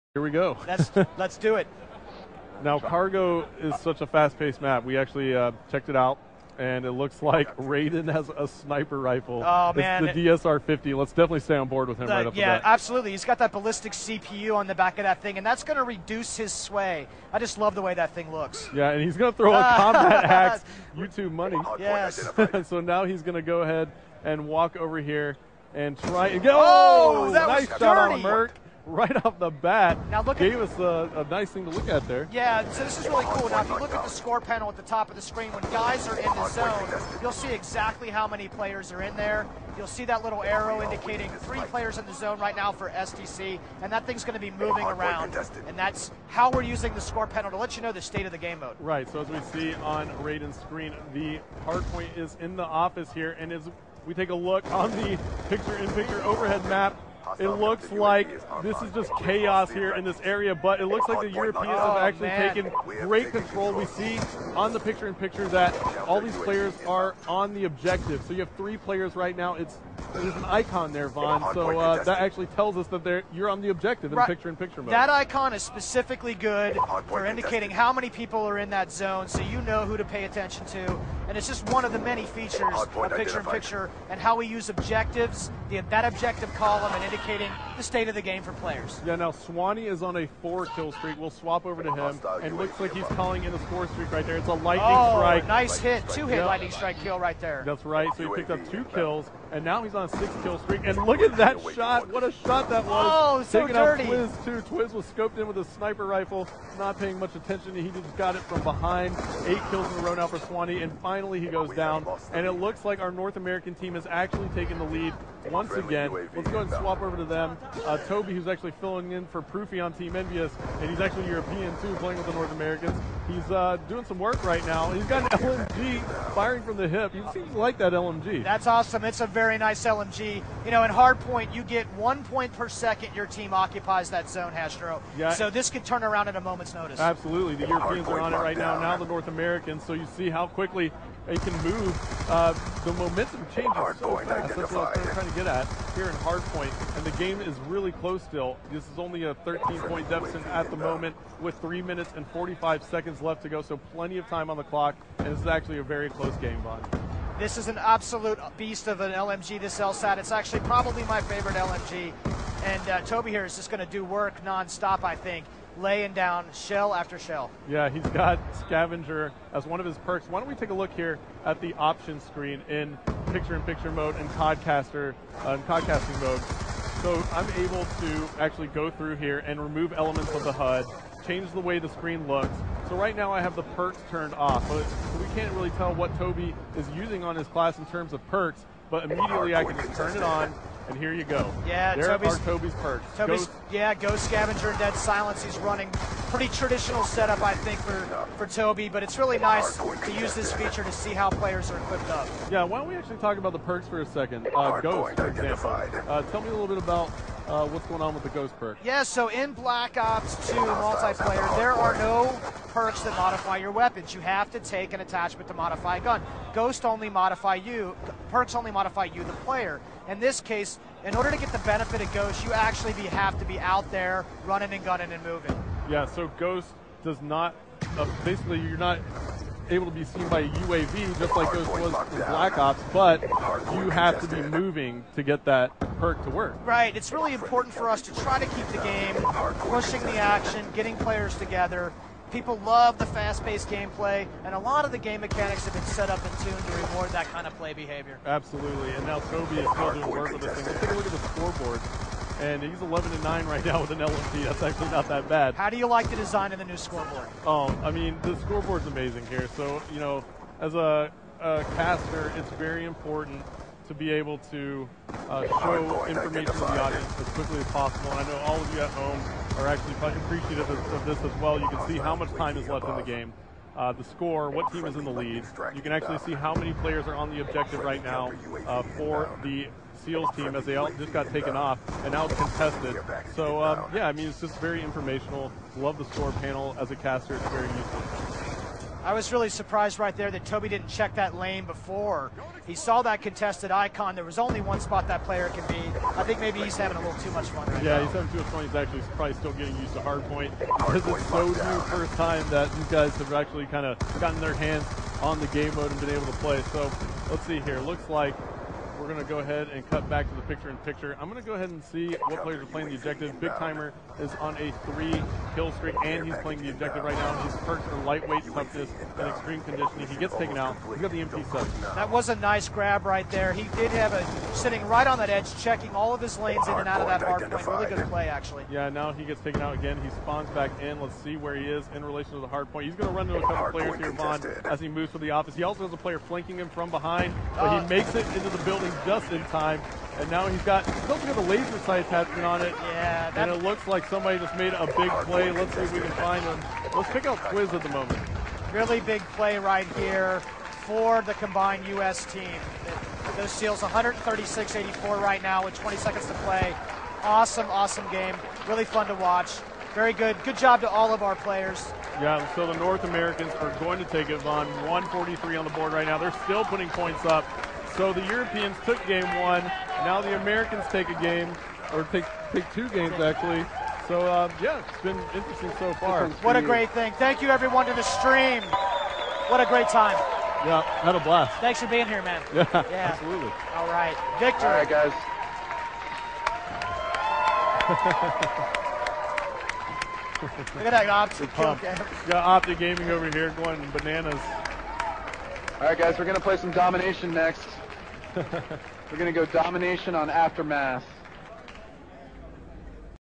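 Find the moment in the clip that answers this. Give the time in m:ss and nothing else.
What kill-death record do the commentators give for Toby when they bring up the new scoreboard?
4:12.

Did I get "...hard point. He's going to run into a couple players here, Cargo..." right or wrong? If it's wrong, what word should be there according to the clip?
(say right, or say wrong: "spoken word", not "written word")
wrong: "Vaughn", not "Cargo".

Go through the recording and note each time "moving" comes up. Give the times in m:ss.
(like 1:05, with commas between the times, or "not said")
0:44, 3:45, 3:54.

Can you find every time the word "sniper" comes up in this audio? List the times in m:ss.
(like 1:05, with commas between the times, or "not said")
0:08, 1:45.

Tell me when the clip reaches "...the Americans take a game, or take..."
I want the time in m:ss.
6:10.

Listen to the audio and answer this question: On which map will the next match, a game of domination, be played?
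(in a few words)
Aftermath.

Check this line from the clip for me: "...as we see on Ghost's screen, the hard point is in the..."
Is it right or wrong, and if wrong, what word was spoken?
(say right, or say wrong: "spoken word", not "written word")
wrong: "Raiden", not "Ghost".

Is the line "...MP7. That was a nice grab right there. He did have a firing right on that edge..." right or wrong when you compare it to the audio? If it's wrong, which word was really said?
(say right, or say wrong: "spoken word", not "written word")
wrong: "sitting", not "firing".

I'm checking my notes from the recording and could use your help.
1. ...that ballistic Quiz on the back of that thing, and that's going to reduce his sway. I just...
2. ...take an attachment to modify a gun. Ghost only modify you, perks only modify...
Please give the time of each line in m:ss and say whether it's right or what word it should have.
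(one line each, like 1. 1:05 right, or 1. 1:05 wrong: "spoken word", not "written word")
1. 0:13 wrong: "CPU", not "Quiz"
2. 3:34 right.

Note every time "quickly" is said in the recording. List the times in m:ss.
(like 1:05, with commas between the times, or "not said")
2:20, 4:27.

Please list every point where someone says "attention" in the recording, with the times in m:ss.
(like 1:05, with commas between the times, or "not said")
1:20, 1:47.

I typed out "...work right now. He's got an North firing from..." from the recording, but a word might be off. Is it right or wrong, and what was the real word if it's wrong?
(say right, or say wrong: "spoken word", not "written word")
wrong: "LMG", not "North".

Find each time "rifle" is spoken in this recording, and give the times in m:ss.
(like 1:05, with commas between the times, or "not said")
0:08, 1:46.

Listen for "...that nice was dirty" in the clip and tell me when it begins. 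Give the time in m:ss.
0:27.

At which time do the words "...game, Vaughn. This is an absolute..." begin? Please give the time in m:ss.
2:36.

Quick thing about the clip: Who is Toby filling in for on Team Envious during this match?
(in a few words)
Proofy.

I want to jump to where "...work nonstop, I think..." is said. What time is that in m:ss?
2:44.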